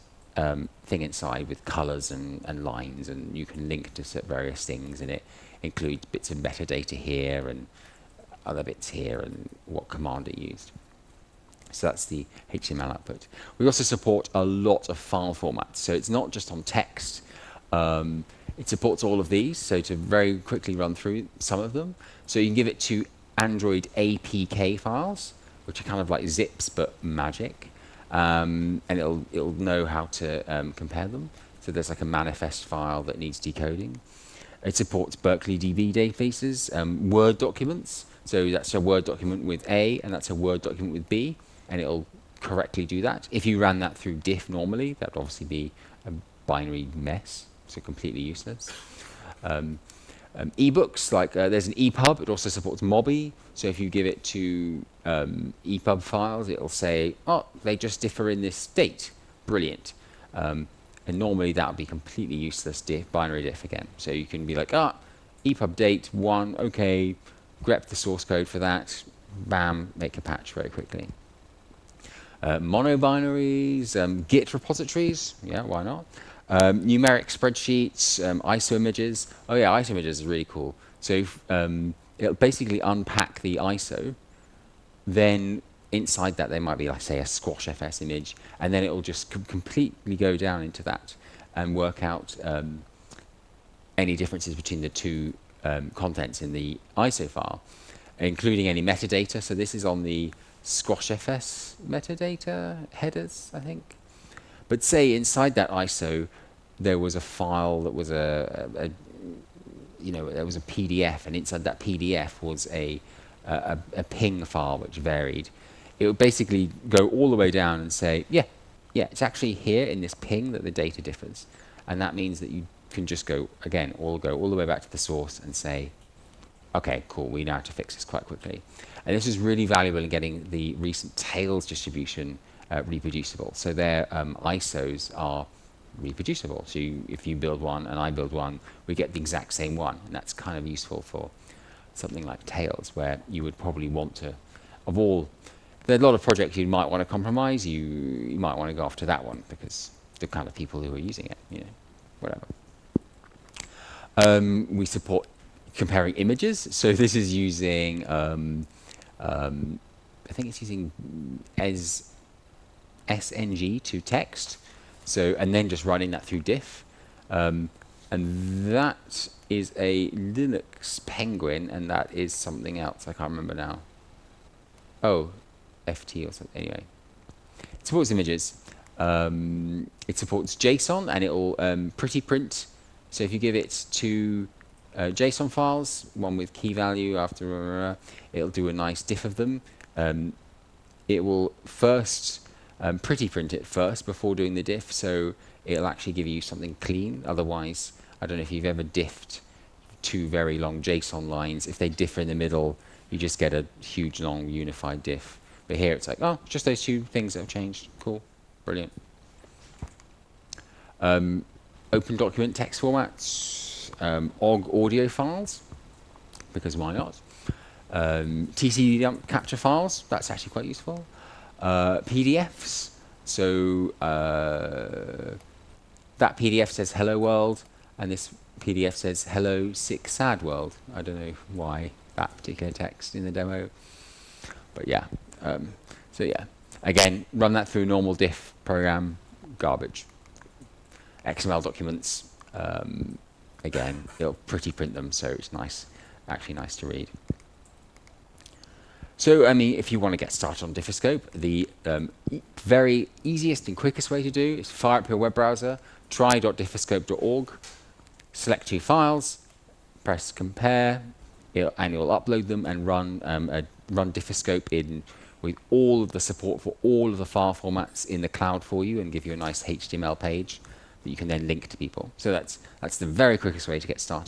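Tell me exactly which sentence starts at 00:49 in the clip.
Um, um, ebooks, like uh, there's an EPUB, it also supports Mobi.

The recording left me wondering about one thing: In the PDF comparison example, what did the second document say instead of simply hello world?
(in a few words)
hello, sick, sad world.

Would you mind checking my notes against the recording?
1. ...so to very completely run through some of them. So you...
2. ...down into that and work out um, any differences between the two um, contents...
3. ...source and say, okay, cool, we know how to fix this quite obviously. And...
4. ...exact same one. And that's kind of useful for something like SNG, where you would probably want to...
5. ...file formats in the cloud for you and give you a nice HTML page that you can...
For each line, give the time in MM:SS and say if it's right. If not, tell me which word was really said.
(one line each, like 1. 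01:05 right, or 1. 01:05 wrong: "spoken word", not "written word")
1. 00:19 wrong: "quickly", not "completely"
2. 01:30 right
3. 02:04 wrong: "quickly", not "obviously"
4. 02:19 wrong: "Tails", not "SNG"
5. 04:27 right.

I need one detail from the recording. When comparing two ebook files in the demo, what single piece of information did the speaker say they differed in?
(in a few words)
date.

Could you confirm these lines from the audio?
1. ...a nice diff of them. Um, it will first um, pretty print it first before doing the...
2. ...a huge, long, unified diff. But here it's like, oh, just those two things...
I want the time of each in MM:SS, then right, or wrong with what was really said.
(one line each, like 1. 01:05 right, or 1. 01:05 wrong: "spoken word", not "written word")
1. 03:08 right
2. 03:23 right.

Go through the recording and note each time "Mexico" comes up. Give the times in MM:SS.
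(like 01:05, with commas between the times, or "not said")
not said.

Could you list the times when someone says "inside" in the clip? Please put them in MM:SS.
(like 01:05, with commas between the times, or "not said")
00:01, 01:25, 01:45, 01:51.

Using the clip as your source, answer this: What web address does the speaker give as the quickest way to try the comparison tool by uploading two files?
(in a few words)
try.diffoscope.org.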